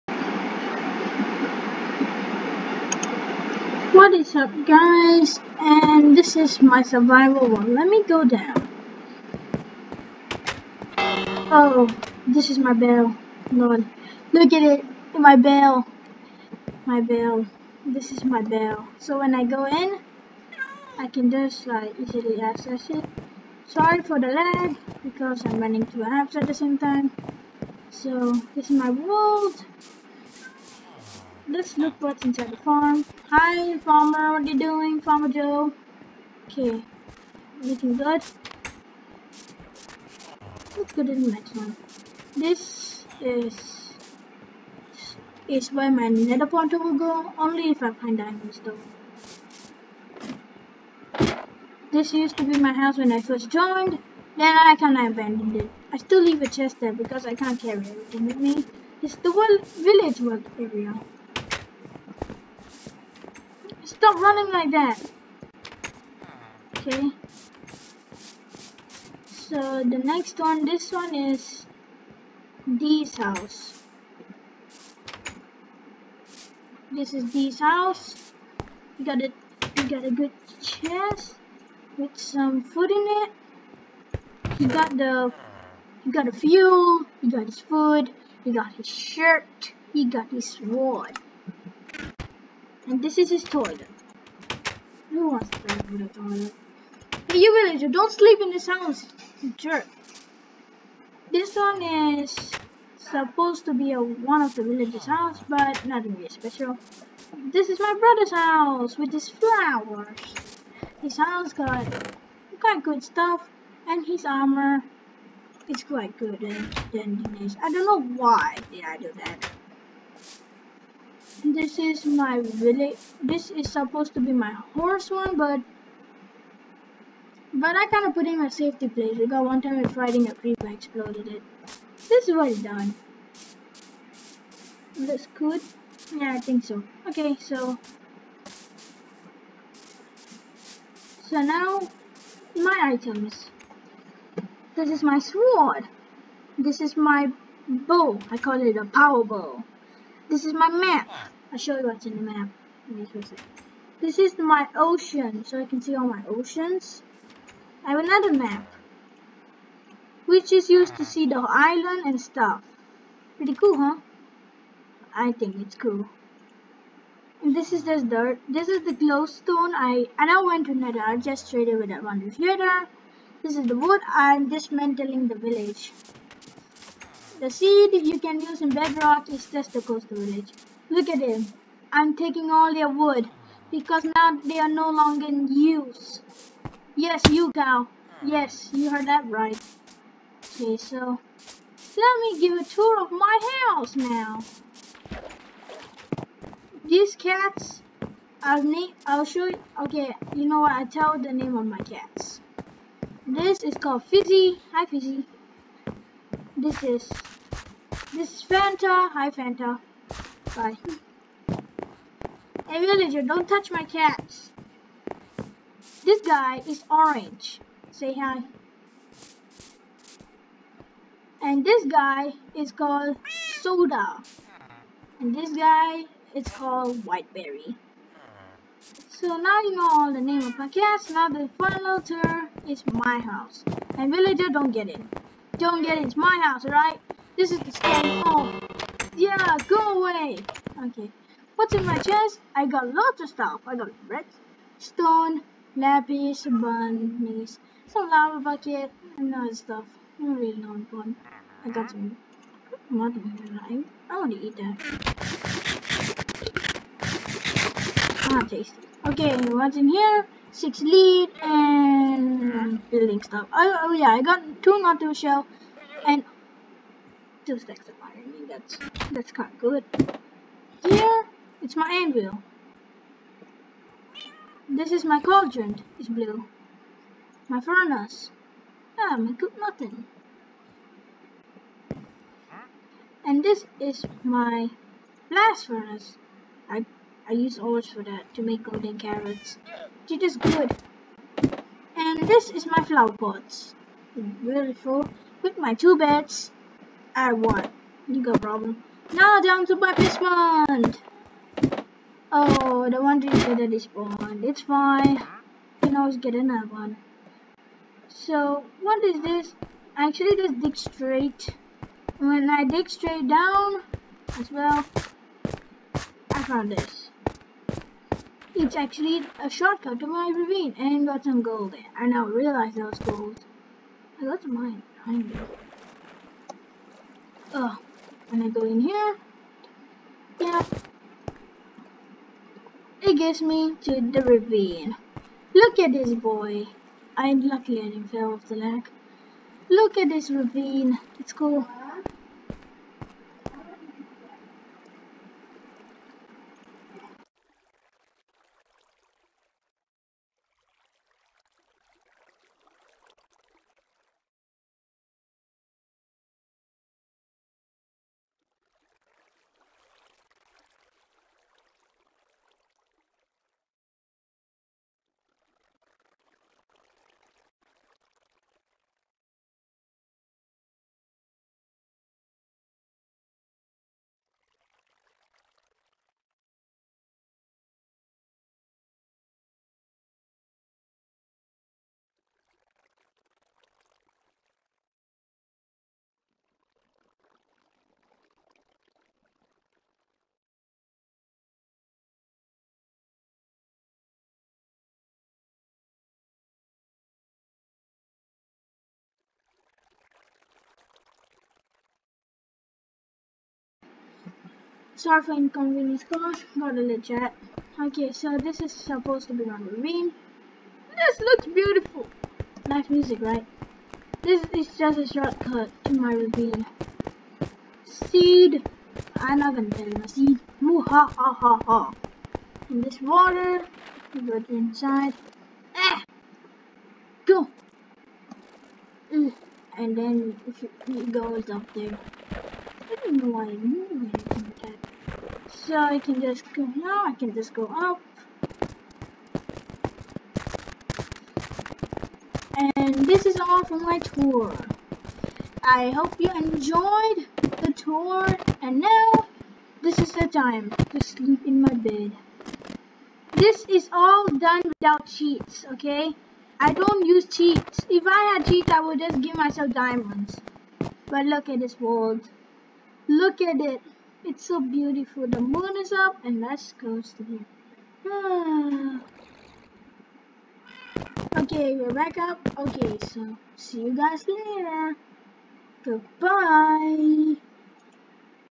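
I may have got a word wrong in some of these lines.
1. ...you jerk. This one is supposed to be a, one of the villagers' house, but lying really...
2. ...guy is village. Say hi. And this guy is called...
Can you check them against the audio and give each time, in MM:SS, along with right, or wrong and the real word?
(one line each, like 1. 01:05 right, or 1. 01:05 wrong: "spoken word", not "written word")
1. 01:39 wrong: "nothing", not "lying"
2. 03:36 wrong: "orange", not "village".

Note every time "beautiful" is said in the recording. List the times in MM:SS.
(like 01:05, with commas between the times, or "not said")
04:54, 06:51, 07:44.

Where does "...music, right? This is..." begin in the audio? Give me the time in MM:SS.
06:52.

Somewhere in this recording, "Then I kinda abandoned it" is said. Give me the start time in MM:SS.
00:54.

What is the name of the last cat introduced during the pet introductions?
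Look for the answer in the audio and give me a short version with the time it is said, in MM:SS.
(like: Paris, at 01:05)
Whiteberry, at 03:47.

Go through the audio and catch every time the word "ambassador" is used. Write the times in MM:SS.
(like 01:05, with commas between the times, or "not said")
not said.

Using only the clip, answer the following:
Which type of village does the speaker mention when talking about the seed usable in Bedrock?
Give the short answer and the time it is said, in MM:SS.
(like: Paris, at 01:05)
Coastal village, at 02:59.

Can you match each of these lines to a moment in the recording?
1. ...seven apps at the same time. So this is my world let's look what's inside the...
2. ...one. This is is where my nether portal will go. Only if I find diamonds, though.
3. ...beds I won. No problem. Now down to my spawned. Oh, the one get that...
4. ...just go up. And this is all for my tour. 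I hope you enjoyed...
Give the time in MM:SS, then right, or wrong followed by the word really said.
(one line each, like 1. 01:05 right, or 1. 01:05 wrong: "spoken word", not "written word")
1. 00:25 wrong: "two", not "seven"
2. 00:41 right
3. 04:55 right
4. 07:17 right.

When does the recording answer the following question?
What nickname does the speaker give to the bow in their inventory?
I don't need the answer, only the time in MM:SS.
02:28.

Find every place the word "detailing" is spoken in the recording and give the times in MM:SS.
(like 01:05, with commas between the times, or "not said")
not said.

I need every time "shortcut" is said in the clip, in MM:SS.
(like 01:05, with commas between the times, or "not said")
05:19, 06:55.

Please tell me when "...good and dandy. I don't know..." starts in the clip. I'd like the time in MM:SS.
01:56.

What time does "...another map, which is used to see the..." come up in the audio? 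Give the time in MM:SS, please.
02:37.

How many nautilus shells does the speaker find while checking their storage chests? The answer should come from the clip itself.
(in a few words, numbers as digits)
2.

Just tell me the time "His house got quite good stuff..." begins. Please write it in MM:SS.
01:51.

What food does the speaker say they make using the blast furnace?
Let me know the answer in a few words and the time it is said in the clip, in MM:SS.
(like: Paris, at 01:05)
Golden carrots, at 04:48.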